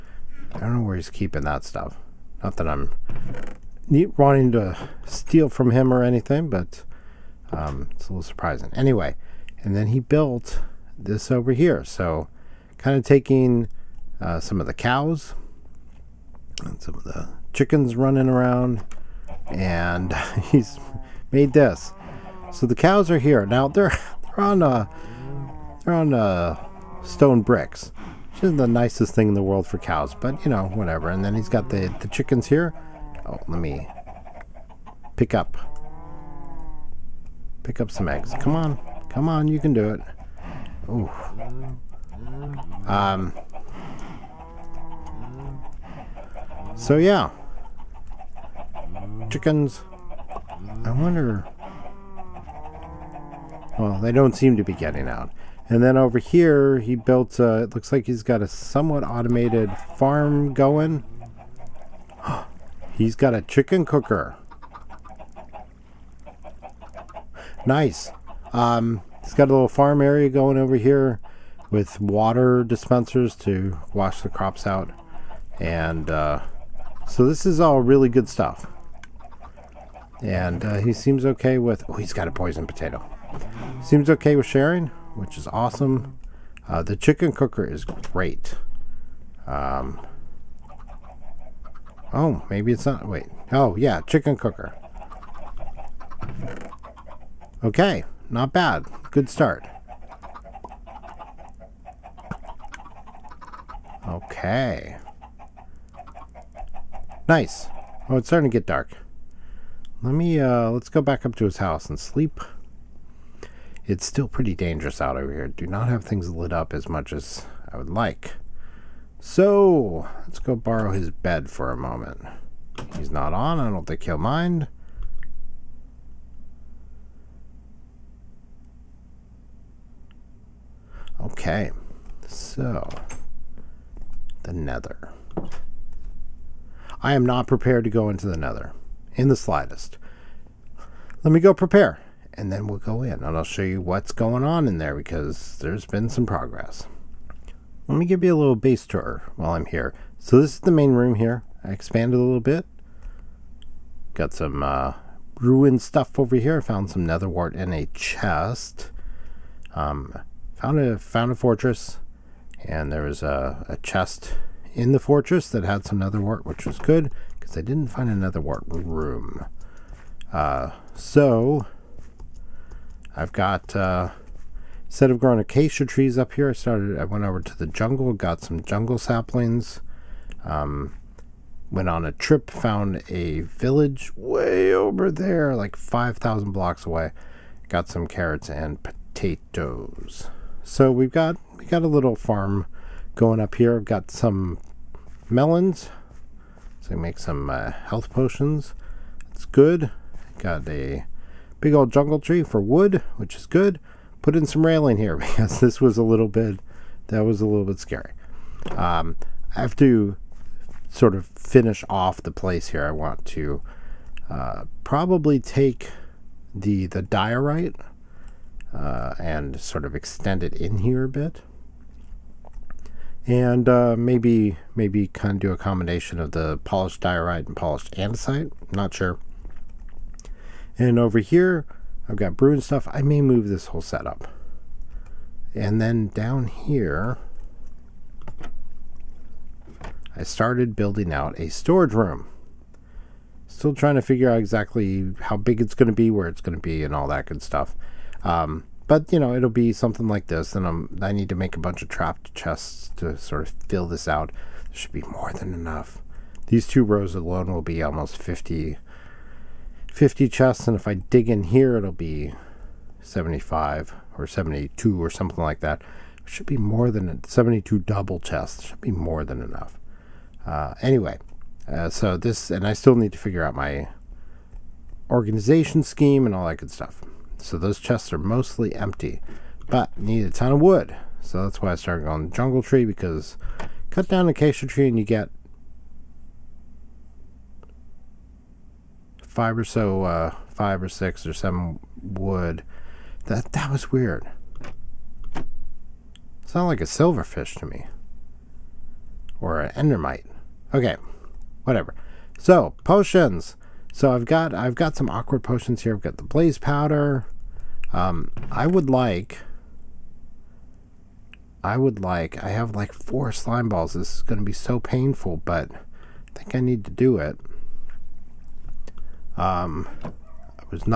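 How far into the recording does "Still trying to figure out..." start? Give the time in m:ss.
4:03.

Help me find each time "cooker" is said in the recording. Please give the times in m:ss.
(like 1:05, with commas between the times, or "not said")
1:03, 1:27, 1:34.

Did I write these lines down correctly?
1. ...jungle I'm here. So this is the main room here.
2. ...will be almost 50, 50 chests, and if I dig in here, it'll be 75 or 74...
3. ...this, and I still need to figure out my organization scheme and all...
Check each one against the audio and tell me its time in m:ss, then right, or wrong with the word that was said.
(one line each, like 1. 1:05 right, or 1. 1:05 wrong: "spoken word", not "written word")
1. 2:29 wrong: "while", not "jungle"
2. 4:17 wrong: "72", not "74"
3. 4:32 right.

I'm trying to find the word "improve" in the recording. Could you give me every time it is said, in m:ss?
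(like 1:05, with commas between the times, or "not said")
not said.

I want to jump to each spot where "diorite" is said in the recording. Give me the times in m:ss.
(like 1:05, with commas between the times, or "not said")
3:37, 3:47.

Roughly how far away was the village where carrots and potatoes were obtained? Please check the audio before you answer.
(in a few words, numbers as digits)
5,000 blocks.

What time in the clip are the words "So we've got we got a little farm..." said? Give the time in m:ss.
3:10.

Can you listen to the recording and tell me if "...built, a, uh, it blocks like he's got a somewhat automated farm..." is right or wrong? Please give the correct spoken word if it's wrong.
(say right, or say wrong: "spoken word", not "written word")
wrong: "looks", not "blocks".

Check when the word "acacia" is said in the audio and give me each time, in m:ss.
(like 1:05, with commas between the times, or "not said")
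2:55, 4:44.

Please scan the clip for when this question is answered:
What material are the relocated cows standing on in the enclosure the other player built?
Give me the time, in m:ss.
0:27.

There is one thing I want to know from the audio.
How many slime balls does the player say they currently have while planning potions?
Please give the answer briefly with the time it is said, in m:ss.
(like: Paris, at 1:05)
4, at 5:12.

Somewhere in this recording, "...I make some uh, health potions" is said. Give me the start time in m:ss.
3:16.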